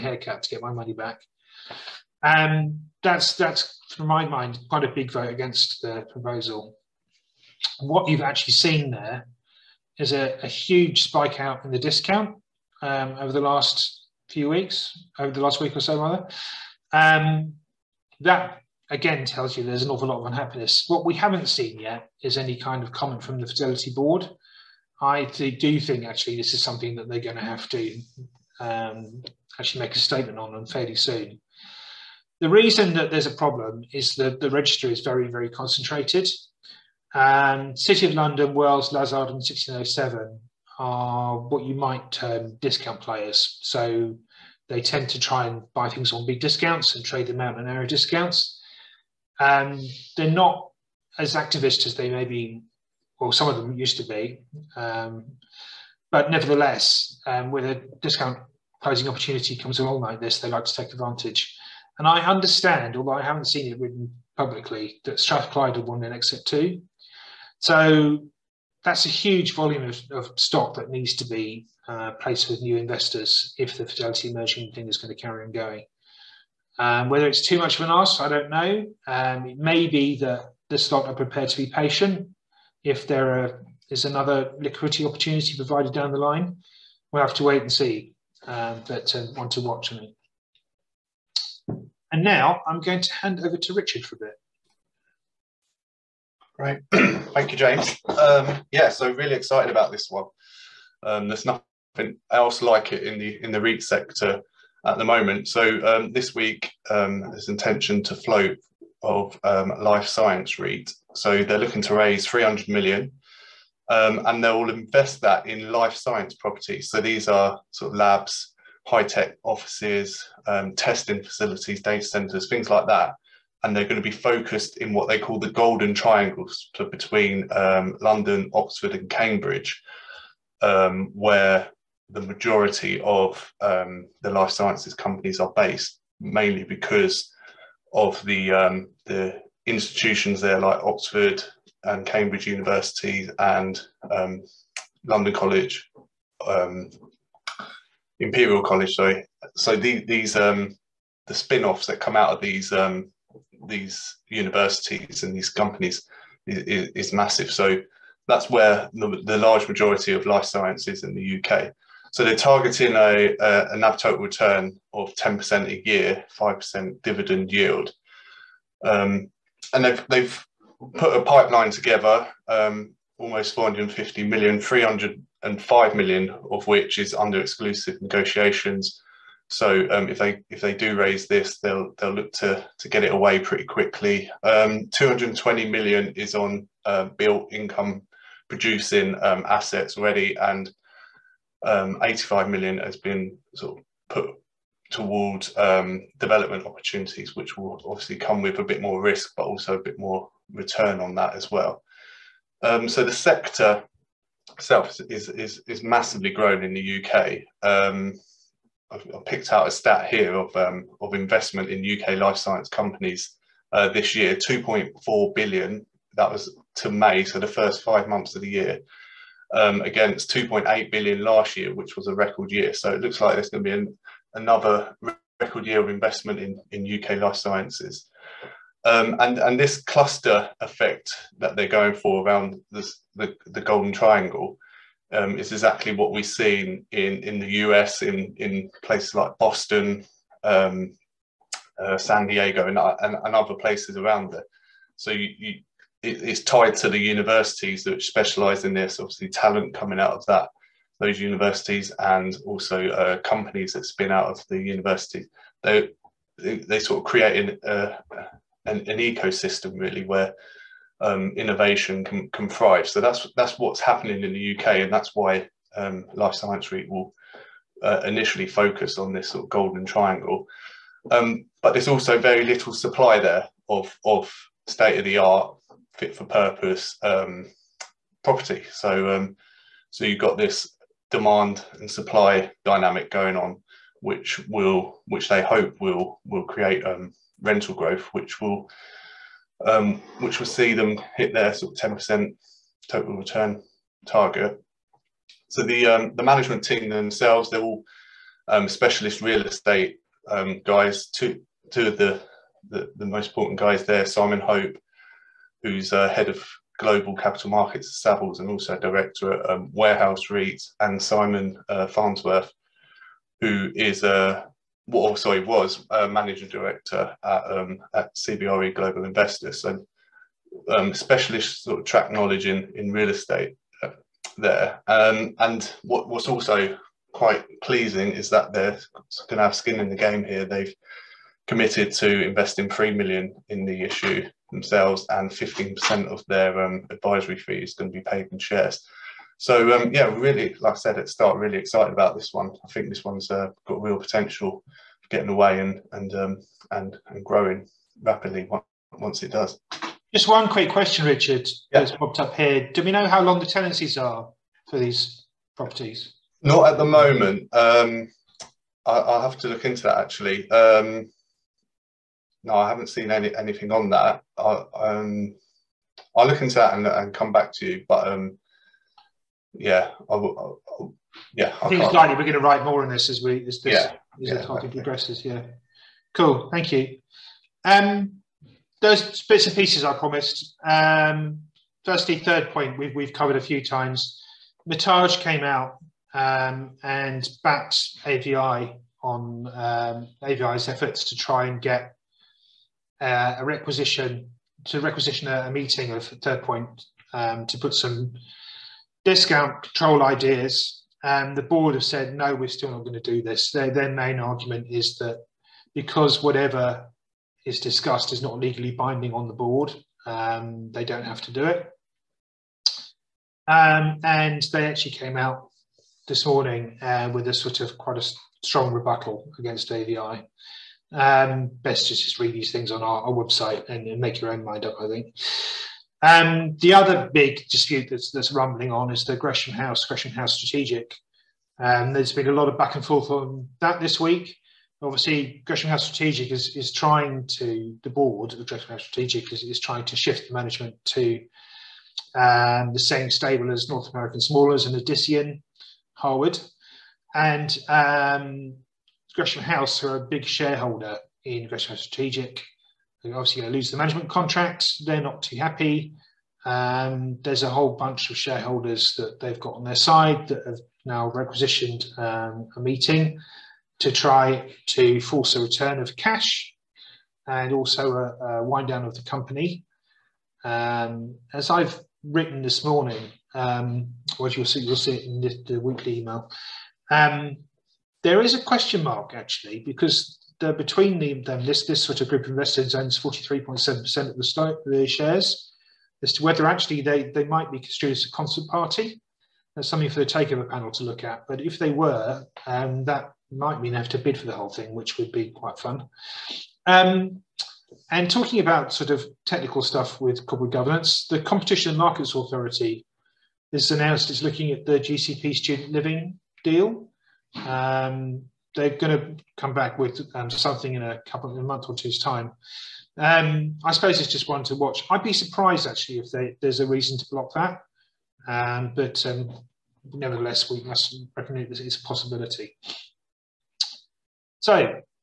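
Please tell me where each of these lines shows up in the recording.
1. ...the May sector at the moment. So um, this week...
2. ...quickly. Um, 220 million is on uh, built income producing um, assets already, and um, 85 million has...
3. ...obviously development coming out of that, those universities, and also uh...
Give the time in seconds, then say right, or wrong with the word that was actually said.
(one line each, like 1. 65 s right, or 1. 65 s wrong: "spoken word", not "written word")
1. 103 s wrong: "REIT", not "May"
2. 183 s right
3. 248 s wrong: "talent", not "development".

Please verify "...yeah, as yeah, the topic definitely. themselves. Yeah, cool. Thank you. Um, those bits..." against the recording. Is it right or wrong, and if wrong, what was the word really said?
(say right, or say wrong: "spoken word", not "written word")
wrong: "progresses", not "themselves".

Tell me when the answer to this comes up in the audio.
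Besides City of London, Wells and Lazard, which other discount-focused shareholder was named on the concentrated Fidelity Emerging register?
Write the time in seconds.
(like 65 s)
39 s.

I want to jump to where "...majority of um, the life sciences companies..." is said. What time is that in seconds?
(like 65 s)
132 s.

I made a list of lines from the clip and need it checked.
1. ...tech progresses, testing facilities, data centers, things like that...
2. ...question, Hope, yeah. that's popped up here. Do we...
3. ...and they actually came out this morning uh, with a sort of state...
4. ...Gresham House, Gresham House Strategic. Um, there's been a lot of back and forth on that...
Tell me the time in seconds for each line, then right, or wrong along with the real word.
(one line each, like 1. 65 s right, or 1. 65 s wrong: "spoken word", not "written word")
1. 119 s wrong: "offices", not "progresses"
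2. 350 s wrong: "Richard", not "Hope"
3. 414 s wrong: "quite", not "state"
4. 429 s right.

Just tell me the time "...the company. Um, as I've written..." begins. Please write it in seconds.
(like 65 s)
468 s.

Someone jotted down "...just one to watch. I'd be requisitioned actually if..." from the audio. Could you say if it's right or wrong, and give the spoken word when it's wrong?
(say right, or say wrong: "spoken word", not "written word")
wrong: "surprised", not "requisitioned".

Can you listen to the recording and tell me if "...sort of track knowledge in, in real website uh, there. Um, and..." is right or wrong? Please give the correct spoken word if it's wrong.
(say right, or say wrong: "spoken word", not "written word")
wrong: "estate", not "website".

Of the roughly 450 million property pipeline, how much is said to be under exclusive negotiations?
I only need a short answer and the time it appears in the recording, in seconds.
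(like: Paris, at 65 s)
305 million, at 174 s.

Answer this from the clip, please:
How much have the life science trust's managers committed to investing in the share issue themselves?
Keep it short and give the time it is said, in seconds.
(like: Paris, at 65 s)
3 million, at 332 s.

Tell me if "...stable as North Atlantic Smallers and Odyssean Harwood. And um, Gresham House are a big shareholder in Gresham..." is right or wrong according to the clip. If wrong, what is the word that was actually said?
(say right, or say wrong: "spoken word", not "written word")
right.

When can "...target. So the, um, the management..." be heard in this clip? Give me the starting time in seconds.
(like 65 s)
294 s.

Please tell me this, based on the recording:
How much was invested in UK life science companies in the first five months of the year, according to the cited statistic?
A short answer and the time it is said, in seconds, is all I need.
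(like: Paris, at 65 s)
2.4 billion, at 214 s.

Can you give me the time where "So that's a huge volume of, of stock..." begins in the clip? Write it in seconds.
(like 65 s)
67 s.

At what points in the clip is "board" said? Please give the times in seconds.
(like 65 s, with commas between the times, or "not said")
23 s, 401 s, 409 s, 437 s.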